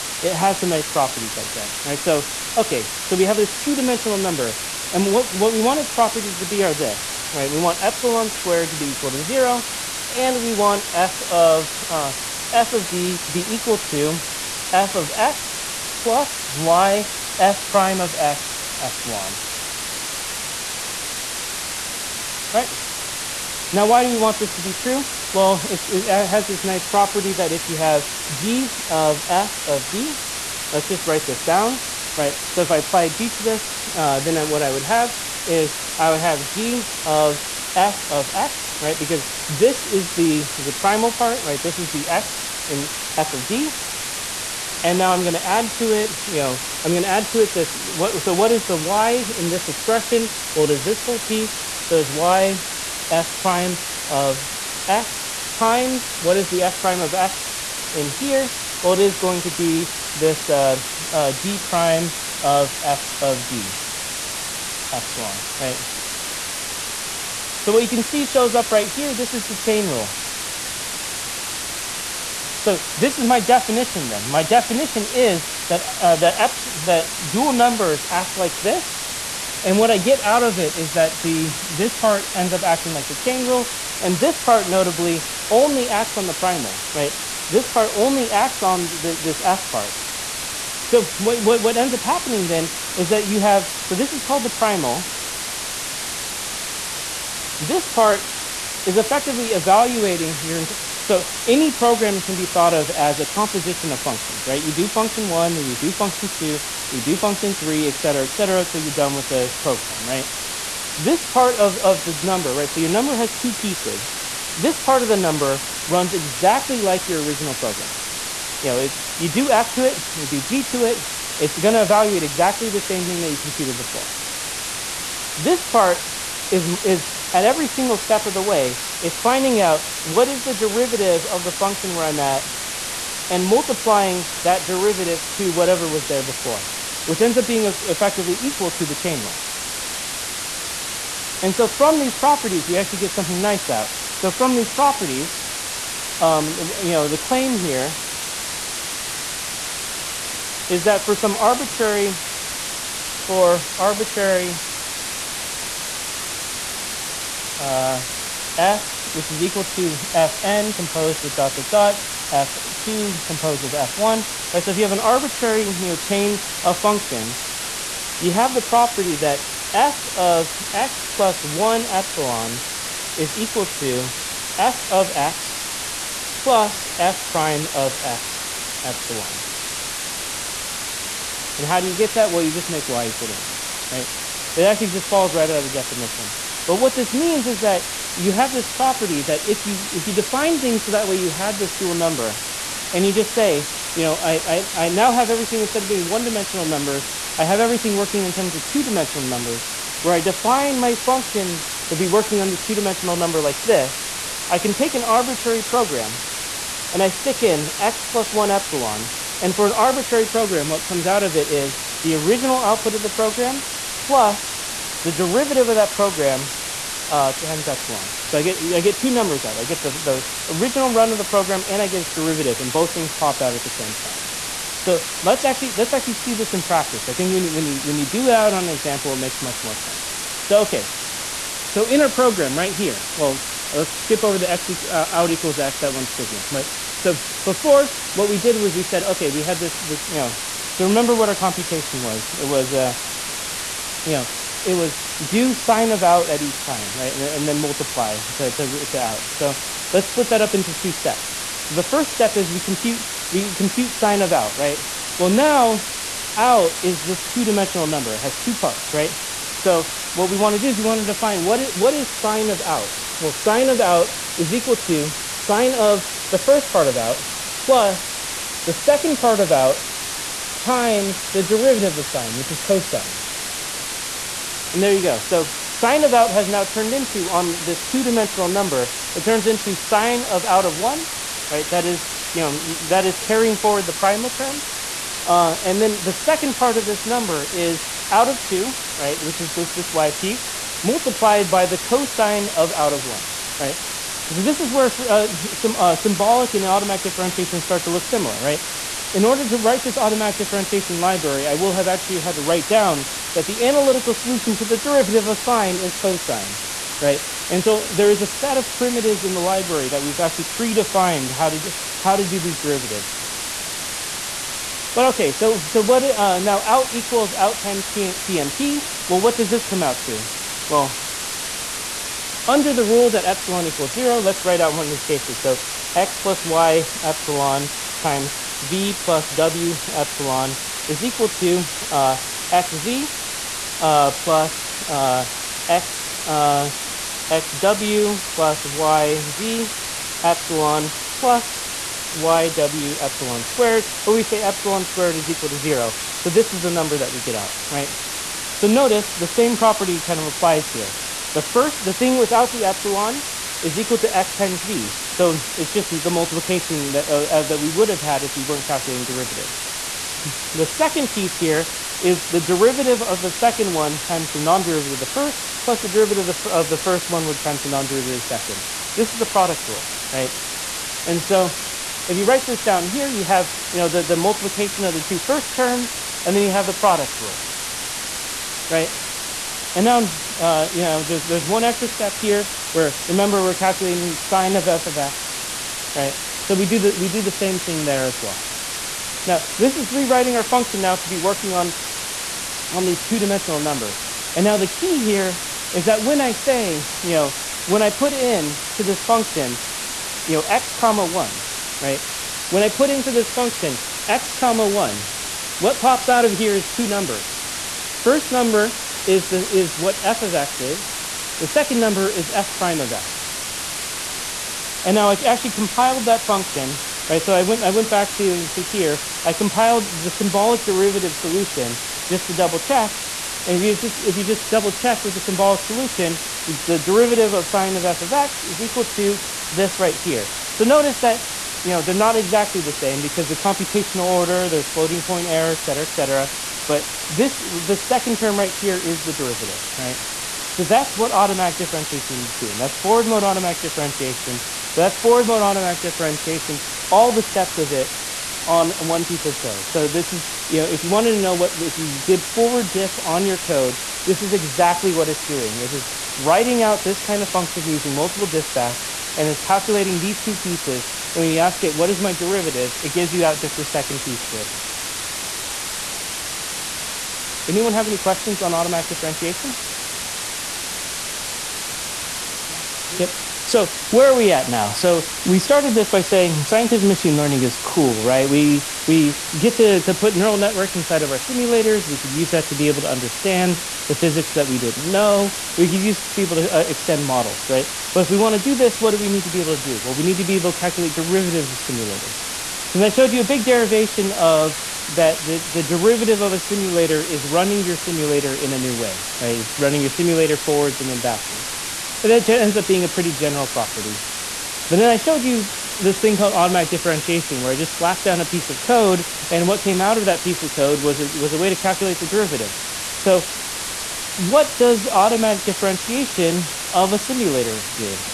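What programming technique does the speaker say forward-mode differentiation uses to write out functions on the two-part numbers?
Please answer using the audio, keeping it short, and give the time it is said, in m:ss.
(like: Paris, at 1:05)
multiple dispatch, at 7:37.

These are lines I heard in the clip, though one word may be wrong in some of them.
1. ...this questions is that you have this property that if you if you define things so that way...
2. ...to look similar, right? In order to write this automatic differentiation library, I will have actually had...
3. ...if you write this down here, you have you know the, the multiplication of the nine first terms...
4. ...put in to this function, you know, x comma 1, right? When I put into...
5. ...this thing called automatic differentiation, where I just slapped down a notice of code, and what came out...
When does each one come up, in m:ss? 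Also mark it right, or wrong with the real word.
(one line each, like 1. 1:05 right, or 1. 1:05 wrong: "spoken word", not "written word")
1. 3:06 wrong: "means", not "questions"
2. 4:57 right
3. 6:12 wrong: "two", not "nine"
4. 6:37 right
5. 8:25 wrong: "piece", not "notice".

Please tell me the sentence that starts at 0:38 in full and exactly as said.
Because this is the, the primal part, right?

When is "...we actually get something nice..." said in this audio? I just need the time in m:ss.
2:22.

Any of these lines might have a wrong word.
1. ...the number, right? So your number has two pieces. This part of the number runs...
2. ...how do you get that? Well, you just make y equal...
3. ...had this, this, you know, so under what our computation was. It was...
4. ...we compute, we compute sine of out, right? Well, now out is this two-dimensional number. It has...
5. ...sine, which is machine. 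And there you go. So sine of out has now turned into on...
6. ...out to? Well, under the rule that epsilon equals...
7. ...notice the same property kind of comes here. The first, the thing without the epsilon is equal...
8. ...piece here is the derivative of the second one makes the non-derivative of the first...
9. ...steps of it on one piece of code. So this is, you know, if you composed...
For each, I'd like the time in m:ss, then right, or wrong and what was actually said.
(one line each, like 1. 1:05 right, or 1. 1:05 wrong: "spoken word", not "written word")
1. 1:52 right
2. 3:01 right
3. 3:59 wrong: "remember", not "under"
4. 4:12 right
5. 4:32 wrong: "cosine", not "machine"
6. 5:19 right
7. 5:48 wrong: "applies", not "comes"
8. 6:01 wrong: "times", not "makes"
9. 7:27 wrong: "wanted", not "composed".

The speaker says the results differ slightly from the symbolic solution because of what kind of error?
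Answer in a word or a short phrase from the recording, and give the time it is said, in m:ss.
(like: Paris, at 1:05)
floating point error, at 7:14.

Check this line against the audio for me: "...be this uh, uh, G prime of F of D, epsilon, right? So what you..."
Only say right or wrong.
right.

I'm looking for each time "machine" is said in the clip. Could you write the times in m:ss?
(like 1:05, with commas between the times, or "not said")
7:56.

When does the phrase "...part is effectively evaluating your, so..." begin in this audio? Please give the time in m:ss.
1:37.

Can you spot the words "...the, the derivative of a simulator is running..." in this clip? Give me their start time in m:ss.
8:15.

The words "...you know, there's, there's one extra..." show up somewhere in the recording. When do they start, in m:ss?
6:20.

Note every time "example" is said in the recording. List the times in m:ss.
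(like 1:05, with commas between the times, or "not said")
3:48.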